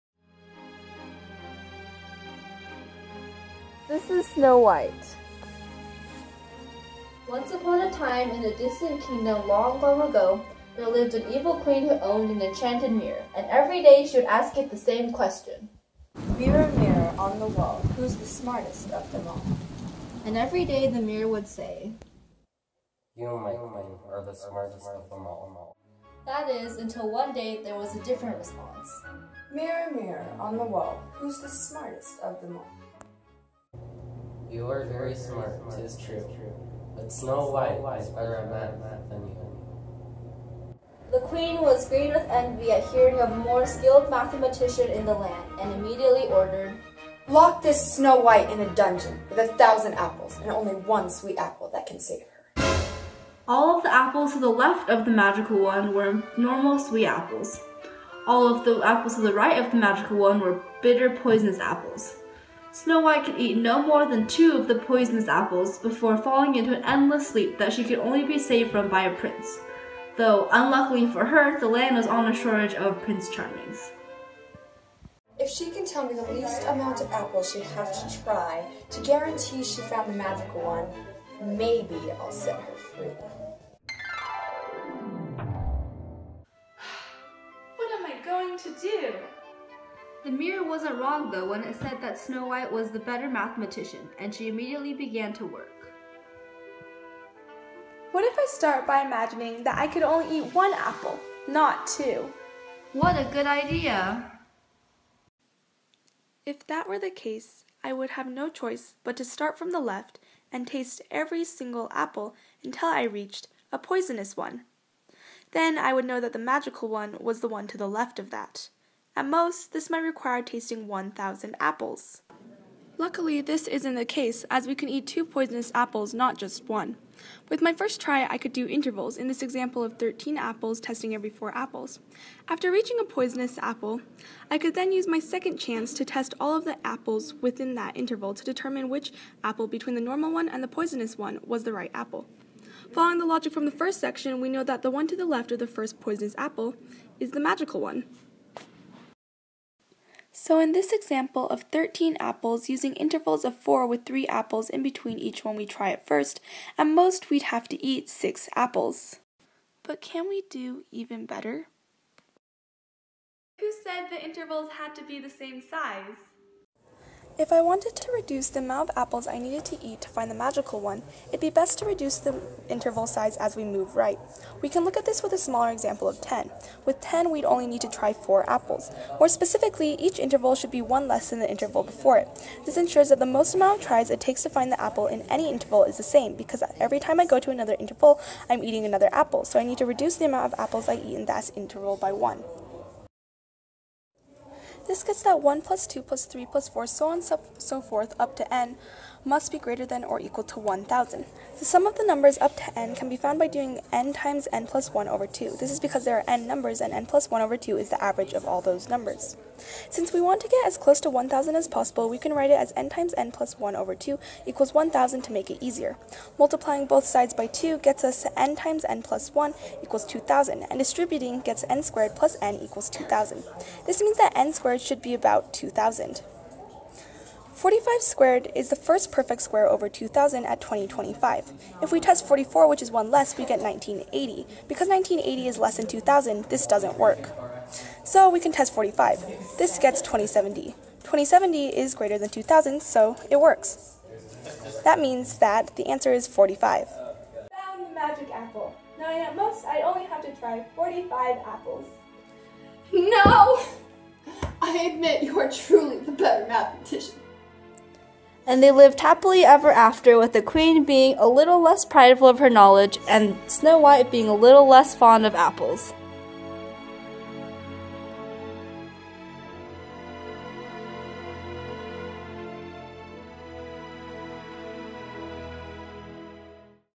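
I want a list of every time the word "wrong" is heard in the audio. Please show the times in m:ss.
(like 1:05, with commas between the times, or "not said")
1:31.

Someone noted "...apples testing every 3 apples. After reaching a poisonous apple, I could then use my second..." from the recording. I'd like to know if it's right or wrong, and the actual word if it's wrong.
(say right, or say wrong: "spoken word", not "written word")
wrong: "4", not "3".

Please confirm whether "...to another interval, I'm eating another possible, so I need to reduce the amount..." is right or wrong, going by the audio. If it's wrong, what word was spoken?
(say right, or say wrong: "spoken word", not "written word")
wrong: "apple", not "possible".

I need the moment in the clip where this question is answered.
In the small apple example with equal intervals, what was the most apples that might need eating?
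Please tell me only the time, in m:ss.
2:38.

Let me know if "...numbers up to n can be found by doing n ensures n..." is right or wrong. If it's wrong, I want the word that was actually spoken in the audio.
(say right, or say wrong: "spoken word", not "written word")
wrong: "times", not "ensures".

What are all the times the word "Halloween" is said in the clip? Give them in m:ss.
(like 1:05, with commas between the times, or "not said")
not said.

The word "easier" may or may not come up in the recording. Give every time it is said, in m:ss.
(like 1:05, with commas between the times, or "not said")
3:35.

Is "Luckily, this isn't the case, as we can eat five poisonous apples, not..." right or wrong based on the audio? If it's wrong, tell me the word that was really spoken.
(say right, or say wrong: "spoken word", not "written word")
wrong: "two", not "five".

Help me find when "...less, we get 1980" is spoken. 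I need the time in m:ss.
3:53.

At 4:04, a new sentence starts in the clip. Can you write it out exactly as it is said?
That means that the answer is 45.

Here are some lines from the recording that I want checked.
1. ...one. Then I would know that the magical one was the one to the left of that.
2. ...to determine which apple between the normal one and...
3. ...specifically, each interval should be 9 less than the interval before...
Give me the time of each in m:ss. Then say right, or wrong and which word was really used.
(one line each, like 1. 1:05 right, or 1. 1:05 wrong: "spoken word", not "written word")
1. 1:54 right
2. 2:18 right
3. 2:59 wrong: "1", not "9".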